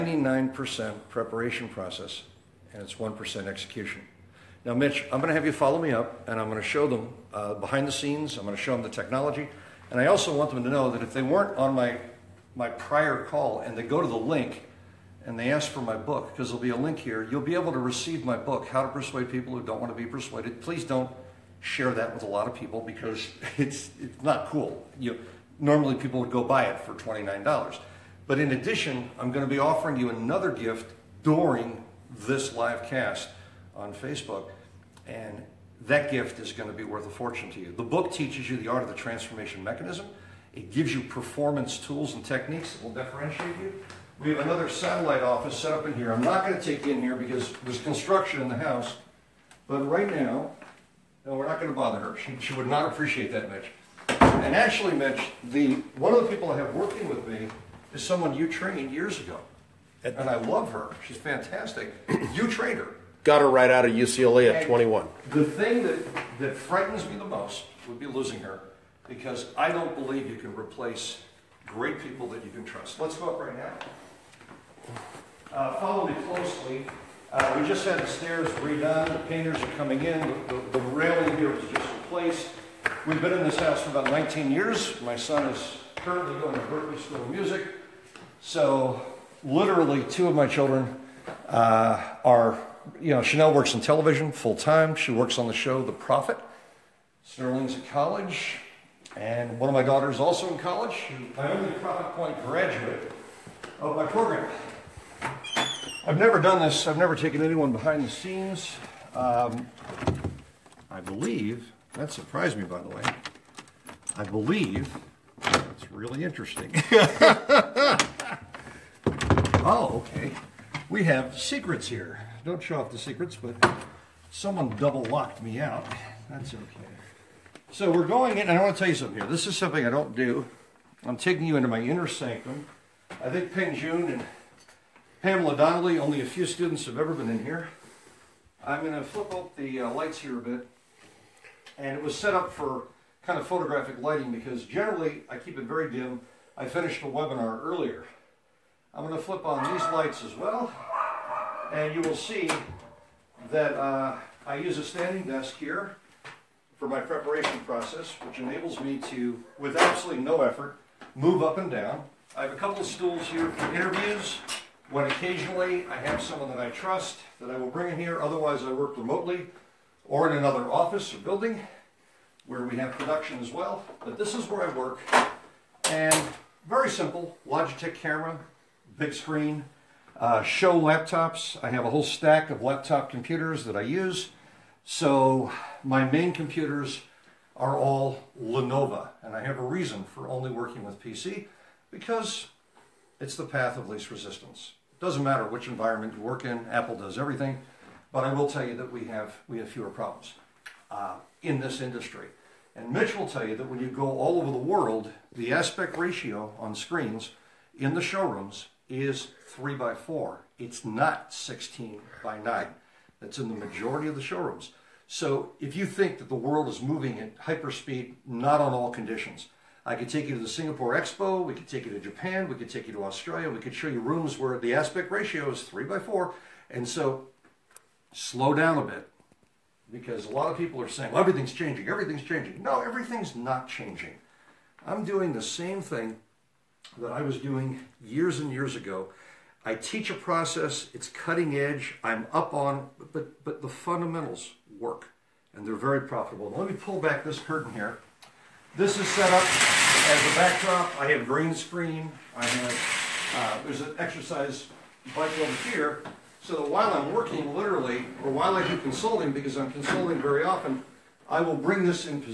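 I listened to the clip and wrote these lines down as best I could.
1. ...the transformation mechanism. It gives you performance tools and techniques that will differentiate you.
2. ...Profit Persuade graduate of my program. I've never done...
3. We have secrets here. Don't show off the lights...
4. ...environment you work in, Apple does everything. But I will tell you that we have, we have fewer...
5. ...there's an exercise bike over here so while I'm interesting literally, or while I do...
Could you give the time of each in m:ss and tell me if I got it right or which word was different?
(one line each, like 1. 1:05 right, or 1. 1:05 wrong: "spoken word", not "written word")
1. 0:38 right
2. 1:41 wrong: "Point", not "Persuade"
3. 2:00 wrong: "secrets", not "lights"
4. 3:15 right
5. 4:13 wrong: "working", not "interesting".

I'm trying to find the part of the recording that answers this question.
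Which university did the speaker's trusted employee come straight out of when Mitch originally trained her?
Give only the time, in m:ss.
1:03.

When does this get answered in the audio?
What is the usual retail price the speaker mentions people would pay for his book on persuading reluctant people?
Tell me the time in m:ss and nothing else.
0:26.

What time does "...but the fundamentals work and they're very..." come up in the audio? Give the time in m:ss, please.
4:03.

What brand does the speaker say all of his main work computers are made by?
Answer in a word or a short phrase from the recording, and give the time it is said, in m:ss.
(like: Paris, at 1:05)
Lenovo, at 3:08.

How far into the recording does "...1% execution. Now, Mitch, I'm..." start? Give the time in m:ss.
0:02.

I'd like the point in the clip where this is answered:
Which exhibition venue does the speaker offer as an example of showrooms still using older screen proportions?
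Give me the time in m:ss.
3:40.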